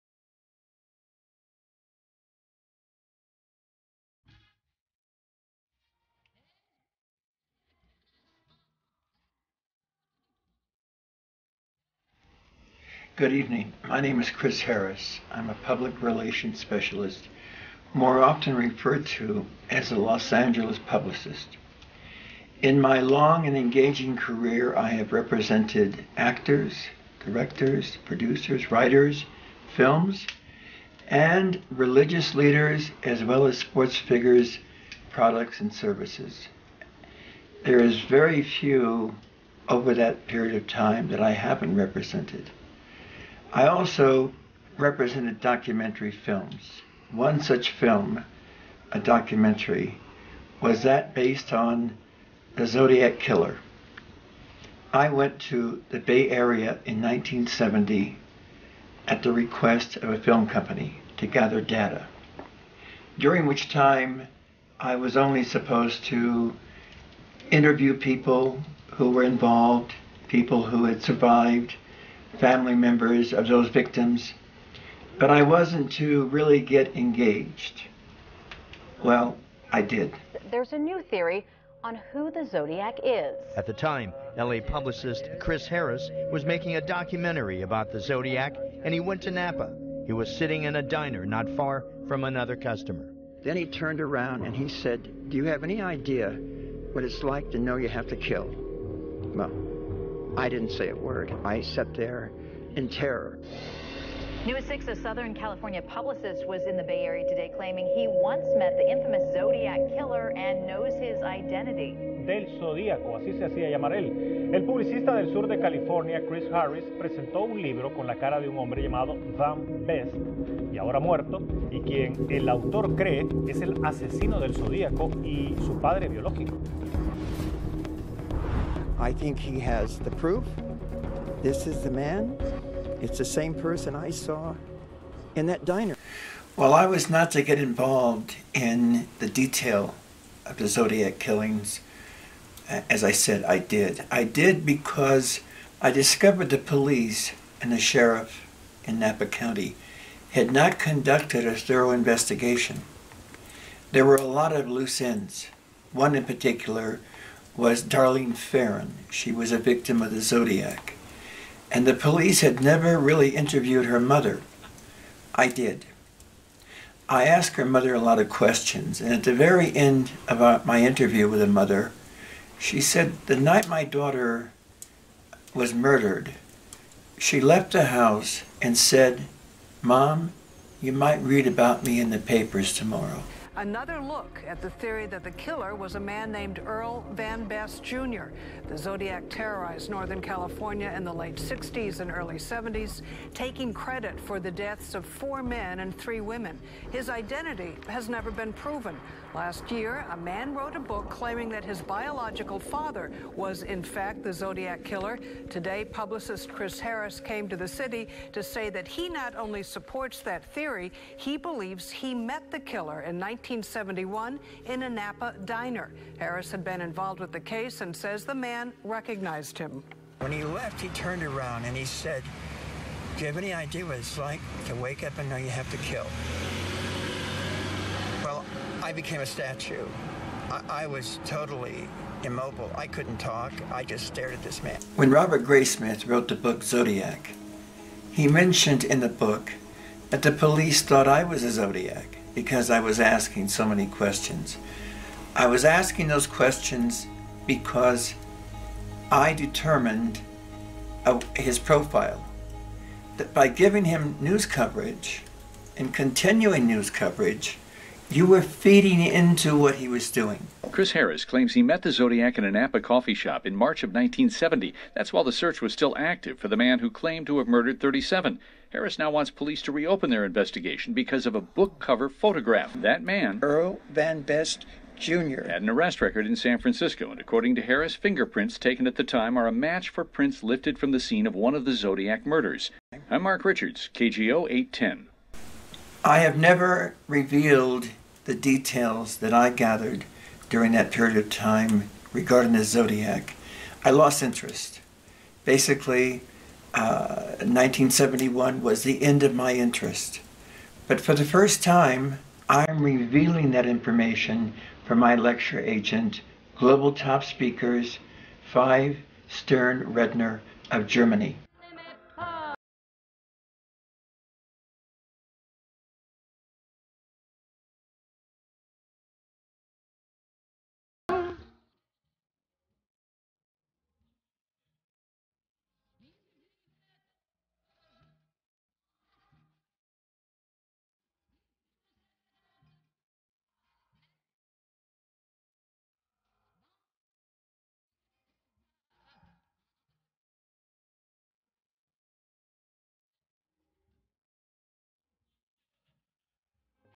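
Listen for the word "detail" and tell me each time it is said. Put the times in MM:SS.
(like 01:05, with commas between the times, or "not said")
02:19, 04:48.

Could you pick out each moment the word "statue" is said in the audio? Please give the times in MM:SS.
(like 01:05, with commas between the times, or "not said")
03:49.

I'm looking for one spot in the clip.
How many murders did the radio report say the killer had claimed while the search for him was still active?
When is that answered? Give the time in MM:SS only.
04:27.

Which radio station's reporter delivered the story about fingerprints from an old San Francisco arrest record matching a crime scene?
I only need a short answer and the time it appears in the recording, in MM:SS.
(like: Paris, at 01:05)
KGO 810, at 04:43.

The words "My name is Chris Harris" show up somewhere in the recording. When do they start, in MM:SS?
00:13.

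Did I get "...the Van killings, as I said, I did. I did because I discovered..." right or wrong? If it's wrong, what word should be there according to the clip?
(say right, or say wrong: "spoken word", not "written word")
wrong: "Zodiac", not "Van".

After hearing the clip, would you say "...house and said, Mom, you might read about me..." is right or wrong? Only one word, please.
right.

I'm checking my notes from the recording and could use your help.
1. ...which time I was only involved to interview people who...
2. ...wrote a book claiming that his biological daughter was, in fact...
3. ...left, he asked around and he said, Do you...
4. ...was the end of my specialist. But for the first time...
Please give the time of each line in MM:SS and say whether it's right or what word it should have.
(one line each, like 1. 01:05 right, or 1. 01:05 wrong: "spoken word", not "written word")
1. 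01:03 wrong: "supposed", not "involved"
2. 03:20 wrong: "father", not "daughter"
3. 03:40 wrong: "turned", not "asked"
4. 04:58 wrong: "interest", not "specialist".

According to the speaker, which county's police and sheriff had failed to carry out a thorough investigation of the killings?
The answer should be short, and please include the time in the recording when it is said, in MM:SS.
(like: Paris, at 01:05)
Napa County, at 02:28.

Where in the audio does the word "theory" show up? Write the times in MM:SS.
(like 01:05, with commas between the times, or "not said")
01:21, 03:04, 03:30.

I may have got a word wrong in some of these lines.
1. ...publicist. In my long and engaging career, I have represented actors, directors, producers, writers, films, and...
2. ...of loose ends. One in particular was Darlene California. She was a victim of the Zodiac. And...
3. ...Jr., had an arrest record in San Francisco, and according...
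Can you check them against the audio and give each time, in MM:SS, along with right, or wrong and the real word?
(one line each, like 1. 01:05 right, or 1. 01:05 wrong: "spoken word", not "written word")
1. 00:20 right
2. 02:34 wrong: "Ferrin", not "California"
3. 04:34 right.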